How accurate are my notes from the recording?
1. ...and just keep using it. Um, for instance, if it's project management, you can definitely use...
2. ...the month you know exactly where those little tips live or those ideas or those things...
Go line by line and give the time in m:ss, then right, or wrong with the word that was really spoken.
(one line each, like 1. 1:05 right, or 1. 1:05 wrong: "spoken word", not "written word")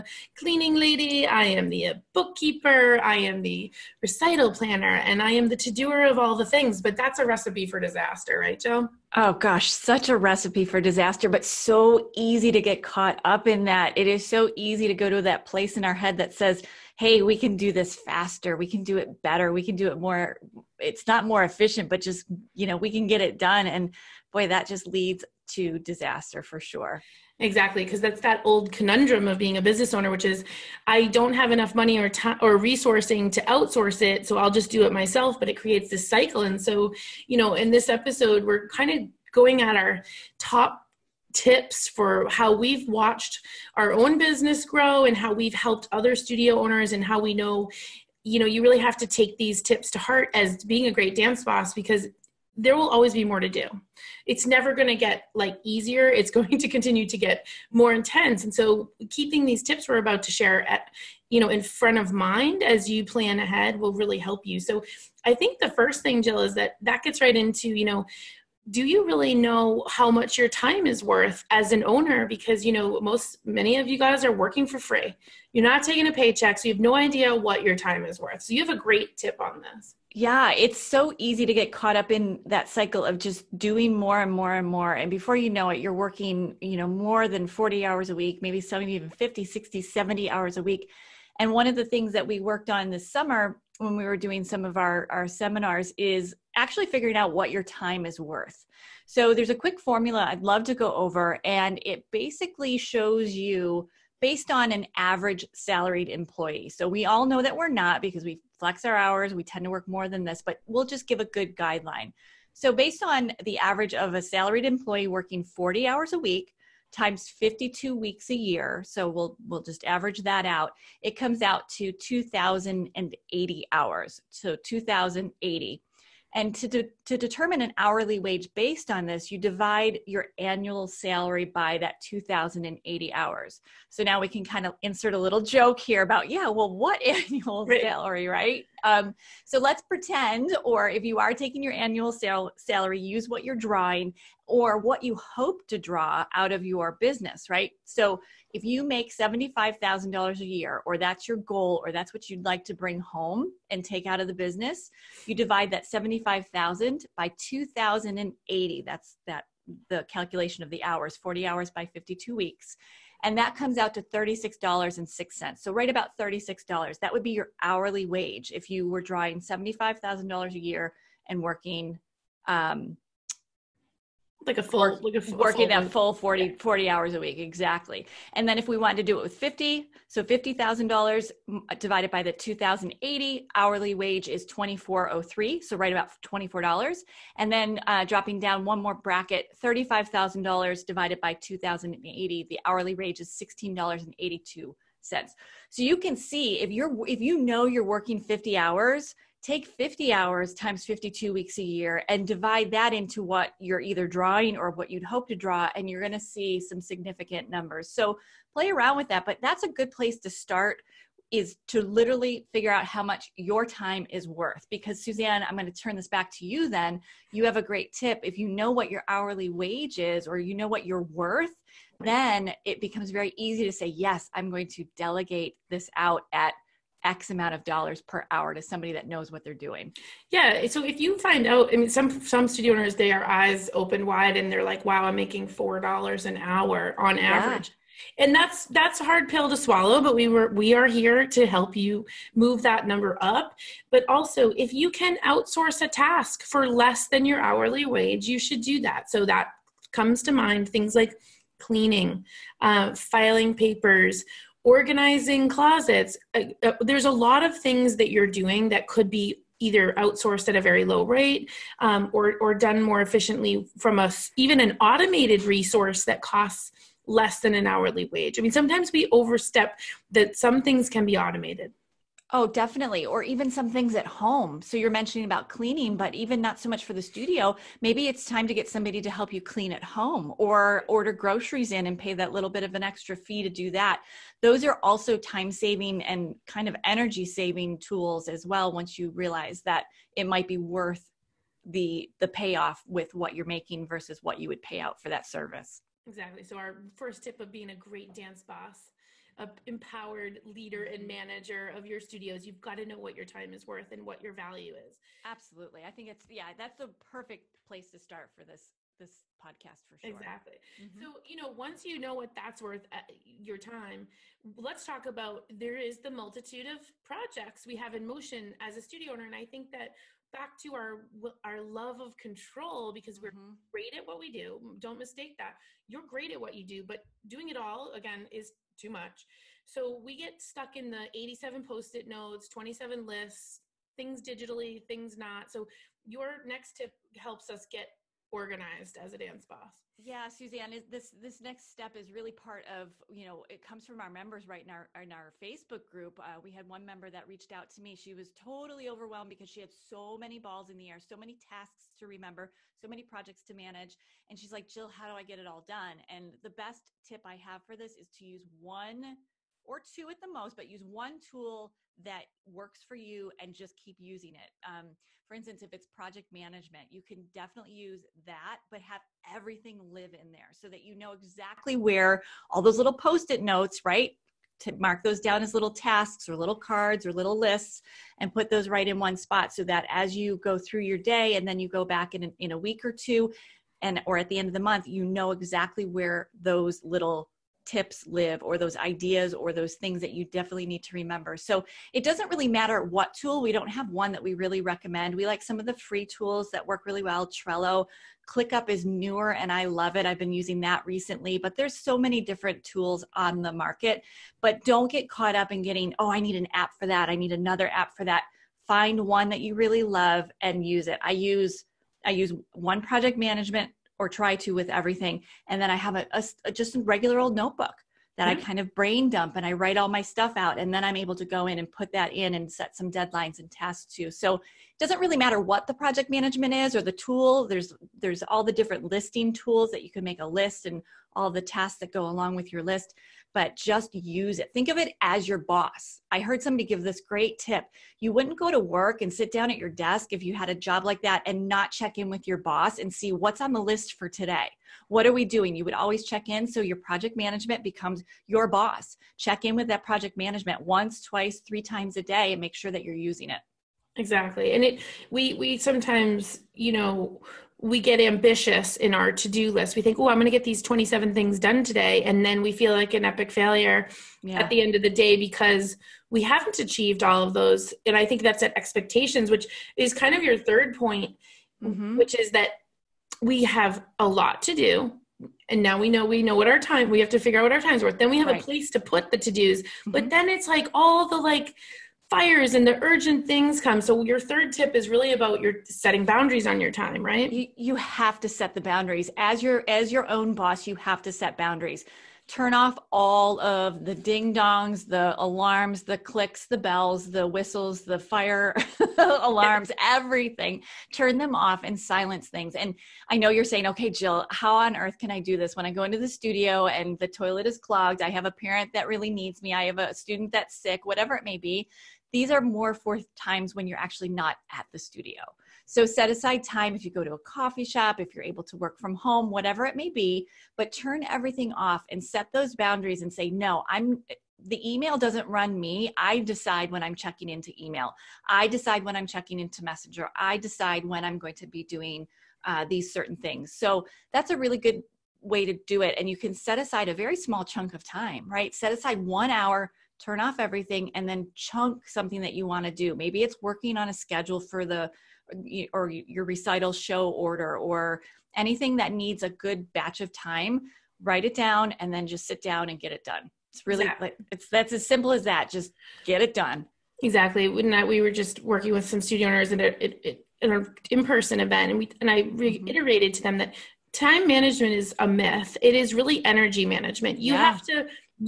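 1. 6:03 right
2. 6:24 right.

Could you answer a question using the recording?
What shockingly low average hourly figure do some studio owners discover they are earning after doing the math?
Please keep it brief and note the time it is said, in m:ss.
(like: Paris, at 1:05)
$4, at 3:55.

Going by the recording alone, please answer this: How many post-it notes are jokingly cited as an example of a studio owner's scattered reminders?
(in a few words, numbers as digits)
87.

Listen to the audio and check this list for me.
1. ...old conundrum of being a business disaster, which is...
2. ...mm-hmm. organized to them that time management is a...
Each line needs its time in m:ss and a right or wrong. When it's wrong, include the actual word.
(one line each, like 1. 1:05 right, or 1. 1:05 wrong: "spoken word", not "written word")
1. 0:28 wrong: "owner", not "disaster"
2. 9:22 wrong: "reiterated", not "organized".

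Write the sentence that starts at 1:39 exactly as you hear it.
So there's a quick formula I'd love to go over and it basically shows you based on an average salaried employee.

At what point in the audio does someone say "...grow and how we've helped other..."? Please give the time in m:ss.
0:44.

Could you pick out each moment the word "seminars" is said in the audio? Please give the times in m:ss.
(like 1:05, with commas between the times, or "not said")
1:35.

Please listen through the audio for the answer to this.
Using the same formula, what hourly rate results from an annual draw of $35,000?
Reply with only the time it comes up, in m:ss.
3:13.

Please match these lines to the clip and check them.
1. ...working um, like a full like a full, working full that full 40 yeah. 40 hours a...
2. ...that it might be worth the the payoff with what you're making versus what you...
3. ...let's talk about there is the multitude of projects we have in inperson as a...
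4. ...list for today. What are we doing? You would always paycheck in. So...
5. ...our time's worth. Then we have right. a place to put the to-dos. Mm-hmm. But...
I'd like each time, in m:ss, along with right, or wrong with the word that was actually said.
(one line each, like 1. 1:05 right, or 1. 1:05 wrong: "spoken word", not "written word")
1. 2:51 right
2. 4:49 right
3. 5:14 wrong: "motion", not "inperson"
4. 7:23 wrong: "check", not "paycheck"
5. 7:57 right.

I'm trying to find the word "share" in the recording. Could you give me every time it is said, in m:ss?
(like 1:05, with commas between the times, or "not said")
1:00.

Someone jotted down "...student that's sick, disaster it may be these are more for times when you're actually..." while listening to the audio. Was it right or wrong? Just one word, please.
wrong.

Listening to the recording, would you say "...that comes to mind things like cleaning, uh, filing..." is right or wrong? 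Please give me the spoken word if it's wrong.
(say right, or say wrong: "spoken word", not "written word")
right.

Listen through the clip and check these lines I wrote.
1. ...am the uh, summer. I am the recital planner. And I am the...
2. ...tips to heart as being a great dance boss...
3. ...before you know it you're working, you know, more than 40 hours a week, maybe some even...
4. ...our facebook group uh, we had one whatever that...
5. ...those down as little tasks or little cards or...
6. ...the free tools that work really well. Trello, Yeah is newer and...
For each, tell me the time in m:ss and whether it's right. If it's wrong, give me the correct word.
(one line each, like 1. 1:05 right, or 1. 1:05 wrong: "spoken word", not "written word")
1. 0:01 wrong: "bookkeeper", not "summer"
2. 0:49 right
3. 1:25 right
4. 5:45 wrong: "member", not "whatever"
5. 6:15 right
6. 6:35 wrong: "ClickUp", not "Yeah".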